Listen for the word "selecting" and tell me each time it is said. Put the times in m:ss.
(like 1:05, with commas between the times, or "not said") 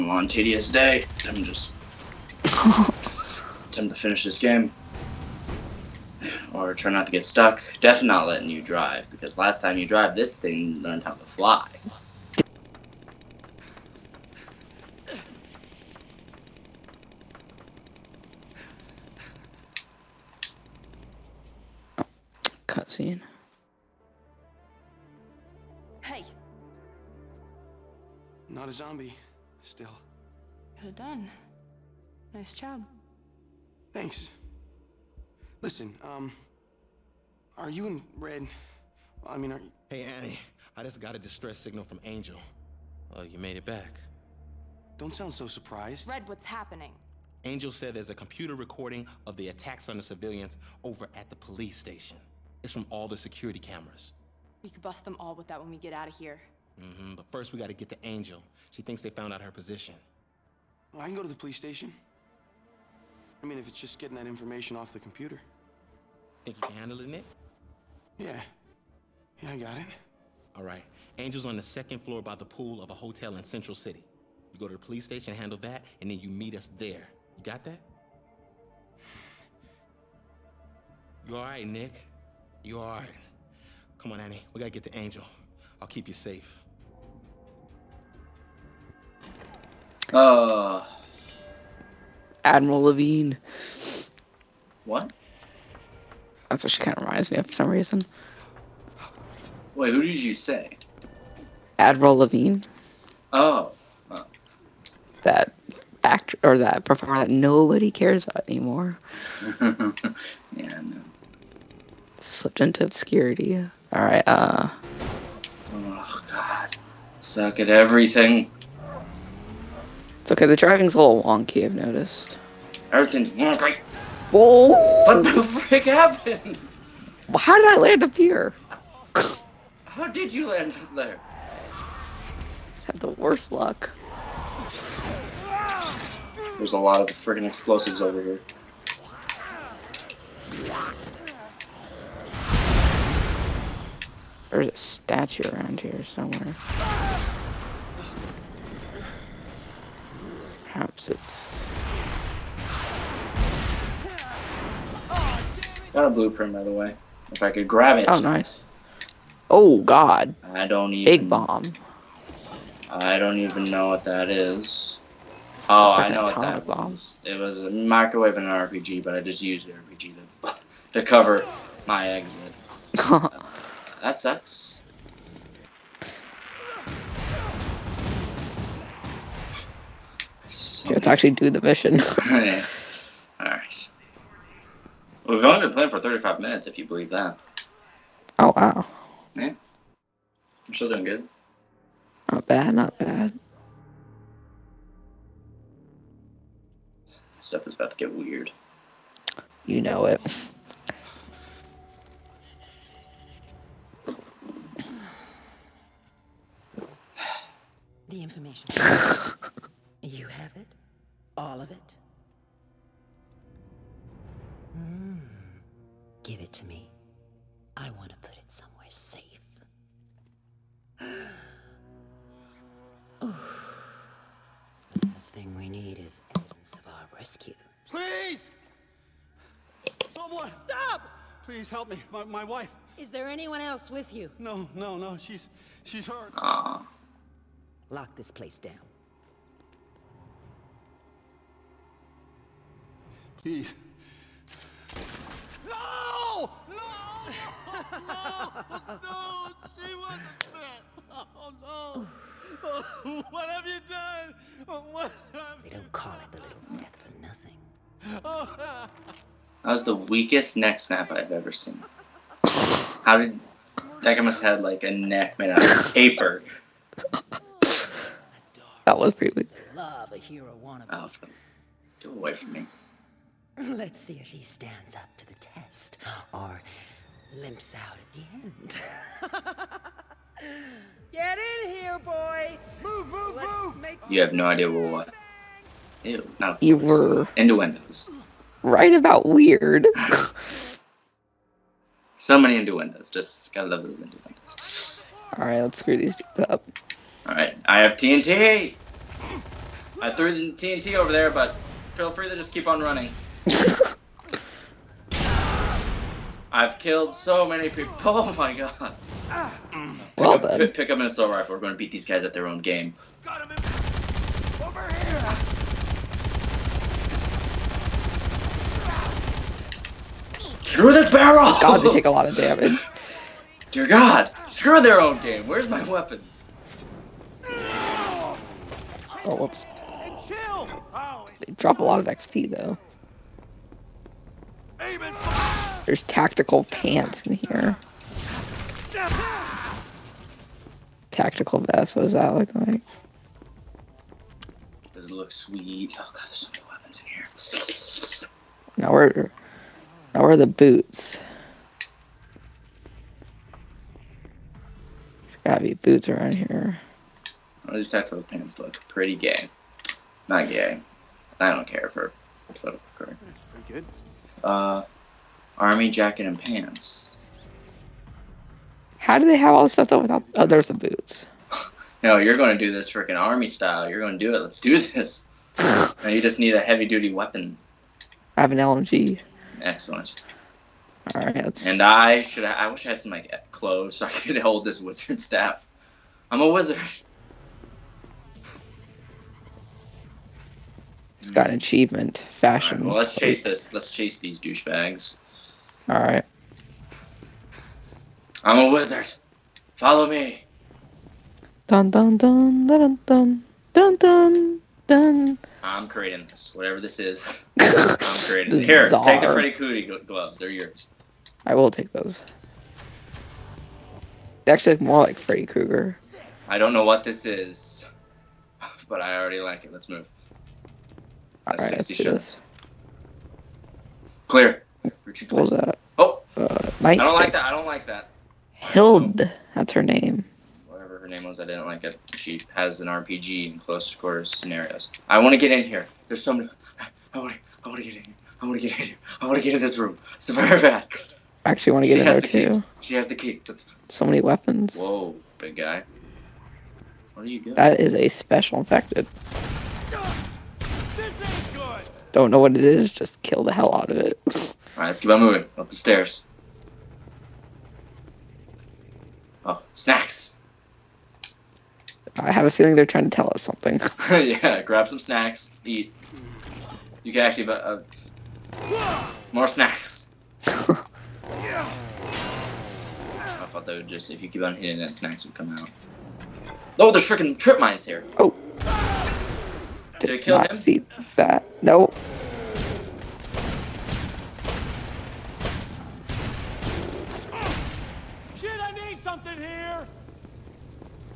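not said.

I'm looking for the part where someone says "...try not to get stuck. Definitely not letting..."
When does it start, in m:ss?
0:06.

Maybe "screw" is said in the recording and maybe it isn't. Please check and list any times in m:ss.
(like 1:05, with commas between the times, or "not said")
4:55, 5:20, 5:24.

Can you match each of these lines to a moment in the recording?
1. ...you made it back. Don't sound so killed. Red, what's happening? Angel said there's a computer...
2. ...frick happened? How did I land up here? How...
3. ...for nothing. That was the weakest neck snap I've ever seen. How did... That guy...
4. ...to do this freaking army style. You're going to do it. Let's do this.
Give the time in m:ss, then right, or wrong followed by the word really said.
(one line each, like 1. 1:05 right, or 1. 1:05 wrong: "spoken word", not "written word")
1. 0:43 wrong: "surprised", not "killed"
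2. 2:05 right
3. 4:16 right
4. 6:12 right.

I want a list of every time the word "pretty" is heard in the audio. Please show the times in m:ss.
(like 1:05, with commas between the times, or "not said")
4:29, 5:58, 6:03.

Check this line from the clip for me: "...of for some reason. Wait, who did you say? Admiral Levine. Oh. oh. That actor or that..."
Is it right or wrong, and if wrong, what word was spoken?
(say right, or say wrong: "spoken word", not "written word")
right.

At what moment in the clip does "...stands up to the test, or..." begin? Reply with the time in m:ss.
4:34.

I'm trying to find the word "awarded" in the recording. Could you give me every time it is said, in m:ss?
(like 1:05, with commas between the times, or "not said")
not said.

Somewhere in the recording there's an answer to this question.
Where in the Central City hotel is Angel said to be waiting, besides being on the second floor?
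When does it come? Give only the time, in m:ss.
1:12.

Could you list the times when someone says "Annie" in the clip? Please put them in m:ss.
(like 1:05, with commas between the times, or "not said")
0:40, 1:24.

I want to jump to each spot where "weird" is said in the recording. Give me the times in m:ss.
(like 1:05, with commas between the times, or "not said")
3:18, 4:49.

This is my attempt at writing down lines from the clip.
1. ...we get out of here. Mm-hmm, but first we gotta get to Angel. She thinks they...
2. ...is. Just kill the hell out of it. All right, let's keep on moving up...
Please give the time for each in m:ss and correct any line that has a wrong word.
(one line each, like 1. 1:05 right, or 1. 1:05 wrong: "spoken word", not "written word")
1. 0:55 right
2. 7:32 right.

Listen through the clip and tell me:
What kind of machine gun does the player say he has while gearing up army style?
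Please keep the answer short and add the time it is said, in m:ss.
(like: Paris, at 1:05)
LMG, at 6:18.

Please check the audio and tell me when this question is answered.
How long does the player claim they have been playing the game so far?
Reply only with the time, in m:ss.
3:05.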